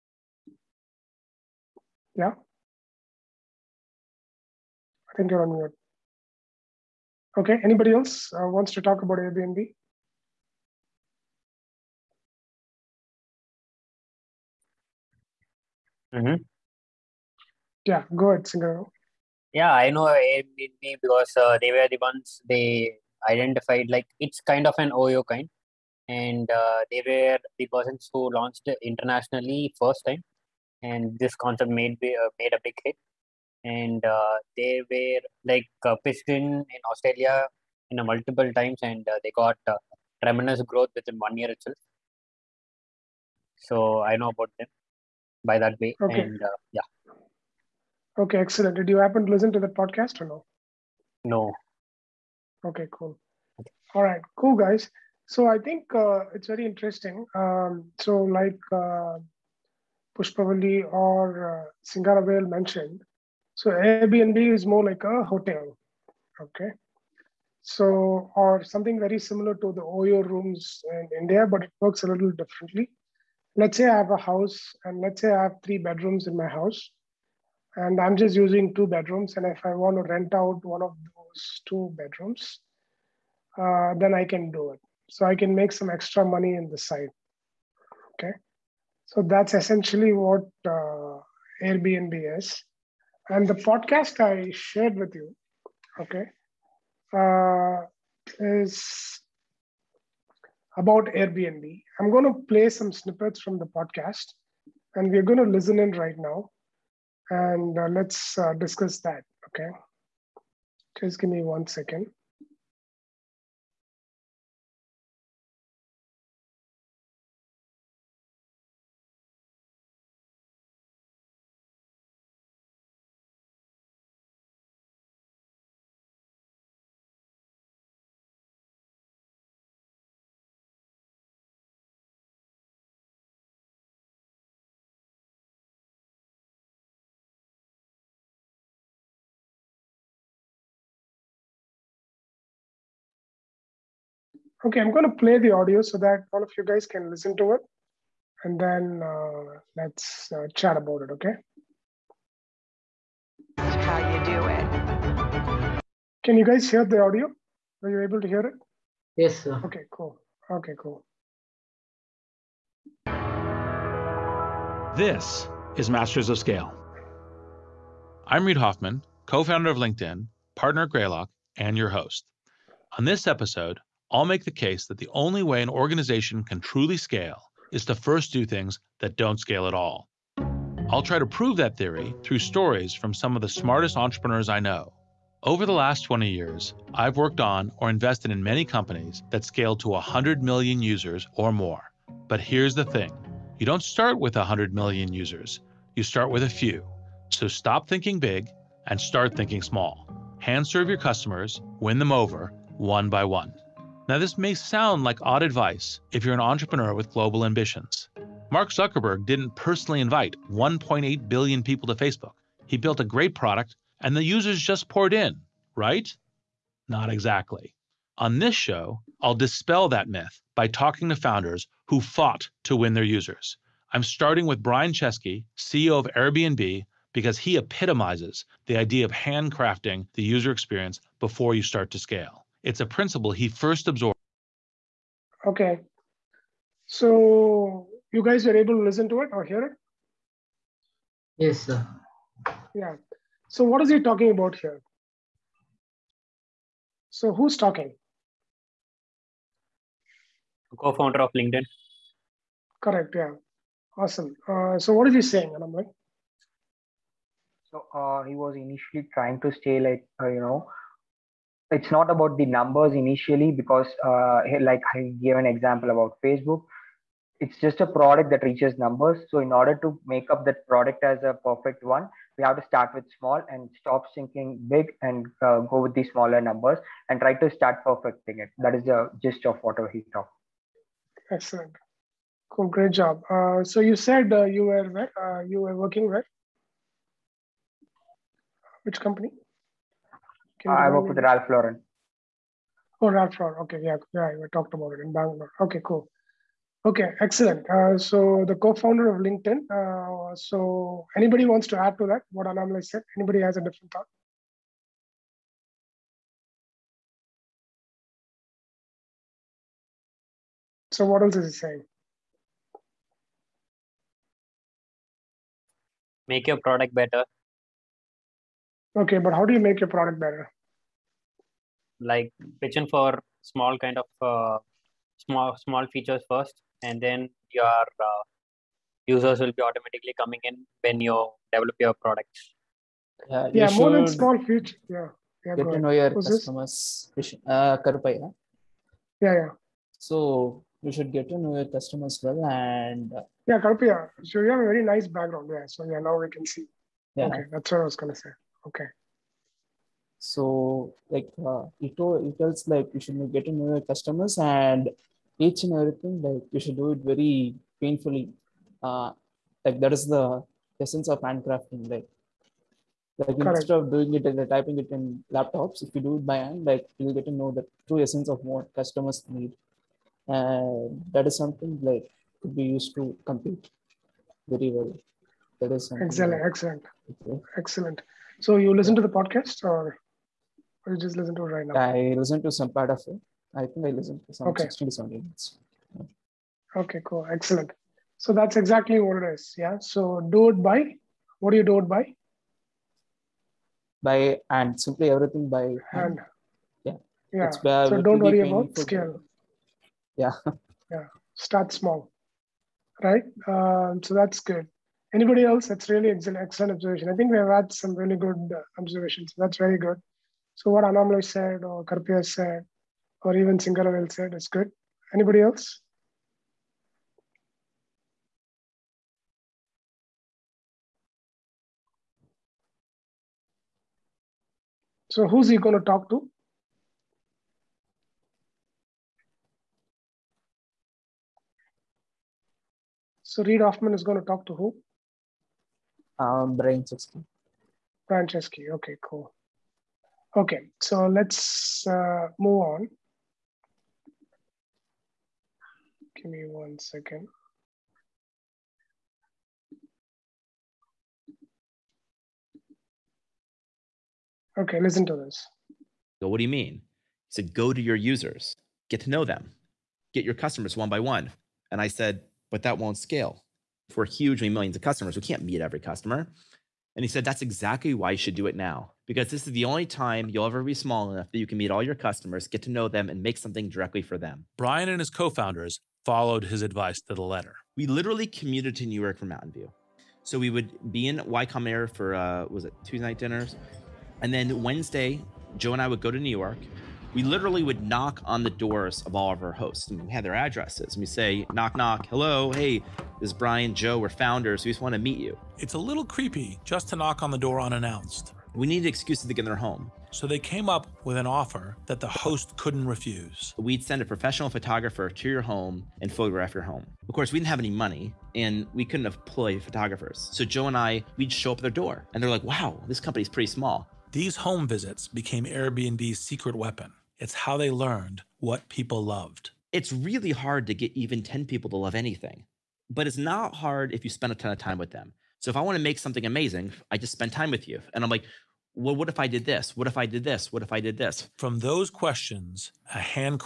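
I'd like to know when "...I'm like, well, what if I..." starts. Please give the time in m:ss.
8:48.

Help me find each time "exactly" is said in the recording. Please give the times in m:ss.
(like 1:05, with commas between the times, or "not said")
3:37, 6:28, 7:47.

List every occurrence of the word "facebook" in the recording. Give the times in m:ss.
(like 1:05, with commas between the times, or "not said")
3:31, 4:26.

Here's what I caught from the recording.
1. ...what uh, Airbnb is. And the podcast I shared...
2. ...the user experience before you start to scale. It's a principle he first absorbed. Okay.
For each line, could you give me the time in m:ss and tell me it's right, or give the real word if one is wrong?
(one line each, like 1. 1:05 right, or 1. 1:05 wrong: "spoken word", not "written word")
1. 1:30 right
2. 3:50 right.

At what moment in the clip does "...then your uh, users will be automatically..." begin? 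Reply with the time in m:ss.
5:27.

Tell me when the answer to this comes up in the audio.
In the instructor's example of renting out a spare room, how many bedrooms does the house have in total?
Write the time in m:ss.
1:15.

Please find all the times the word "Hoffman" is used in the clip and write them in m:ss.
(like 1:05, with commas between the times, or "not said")
2:48, 7:13.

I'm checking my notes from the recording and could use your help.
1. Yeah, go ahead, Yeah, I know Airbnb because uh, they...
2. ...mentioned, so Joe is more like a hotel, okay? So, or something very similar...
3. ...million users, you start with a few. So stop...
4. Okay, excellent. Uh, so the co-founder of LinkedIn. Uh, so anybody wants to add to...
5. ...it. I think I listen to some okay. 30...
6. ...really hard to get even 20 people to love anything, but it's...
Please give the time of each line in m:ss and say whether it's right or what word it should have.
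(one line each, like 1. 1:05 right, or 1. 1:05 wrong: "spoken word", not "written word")
1. 0:17 right
2. 1:02 wrong: "Airbnb", not "Joe"
3. 3:14 right
4. 4:56 right
5. 6:23 wrong: "60", not "30"
6. 8:39 wrong: "10", not "20".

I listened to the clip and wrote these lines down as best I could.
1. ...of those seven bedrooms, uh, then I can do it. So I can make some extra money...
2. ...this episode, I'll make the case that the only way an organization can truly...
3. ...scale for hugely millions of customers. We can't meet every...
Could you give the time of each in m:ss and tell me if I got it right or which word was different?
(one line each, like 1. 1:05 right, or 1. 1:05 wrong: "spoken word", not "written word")
1. 1:20 wrong: "two", not "seven"
2. 2:53 right
3. 7:42 right.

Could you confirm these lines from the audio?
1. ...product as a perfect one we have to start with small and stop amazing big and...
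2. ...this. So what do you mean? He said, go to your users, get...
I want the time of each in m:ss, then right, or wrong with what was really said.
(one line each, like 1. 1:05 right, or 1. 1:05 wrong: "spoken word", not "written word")
1. 4:30 wrong: "thinking", not "amazing"
2. 7:35 right.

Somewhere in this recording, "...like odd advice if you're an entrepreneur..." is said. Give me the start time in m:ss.
3:25.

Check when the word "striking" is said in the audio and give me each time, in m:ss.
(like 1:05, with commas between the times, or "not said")
not said.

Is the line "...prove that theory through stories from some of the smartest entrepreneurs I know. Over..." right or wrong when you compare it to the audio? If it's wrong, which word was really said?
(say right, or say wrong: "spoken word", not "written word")
right.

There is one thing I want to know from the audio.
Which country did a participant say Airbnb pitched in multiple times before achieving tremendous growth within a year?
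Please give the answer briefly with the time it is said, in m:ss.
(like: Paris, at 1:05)
Australia, at 0:36.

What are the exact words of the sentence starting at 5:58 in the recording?
Uh, like that is the essence of handcrafting.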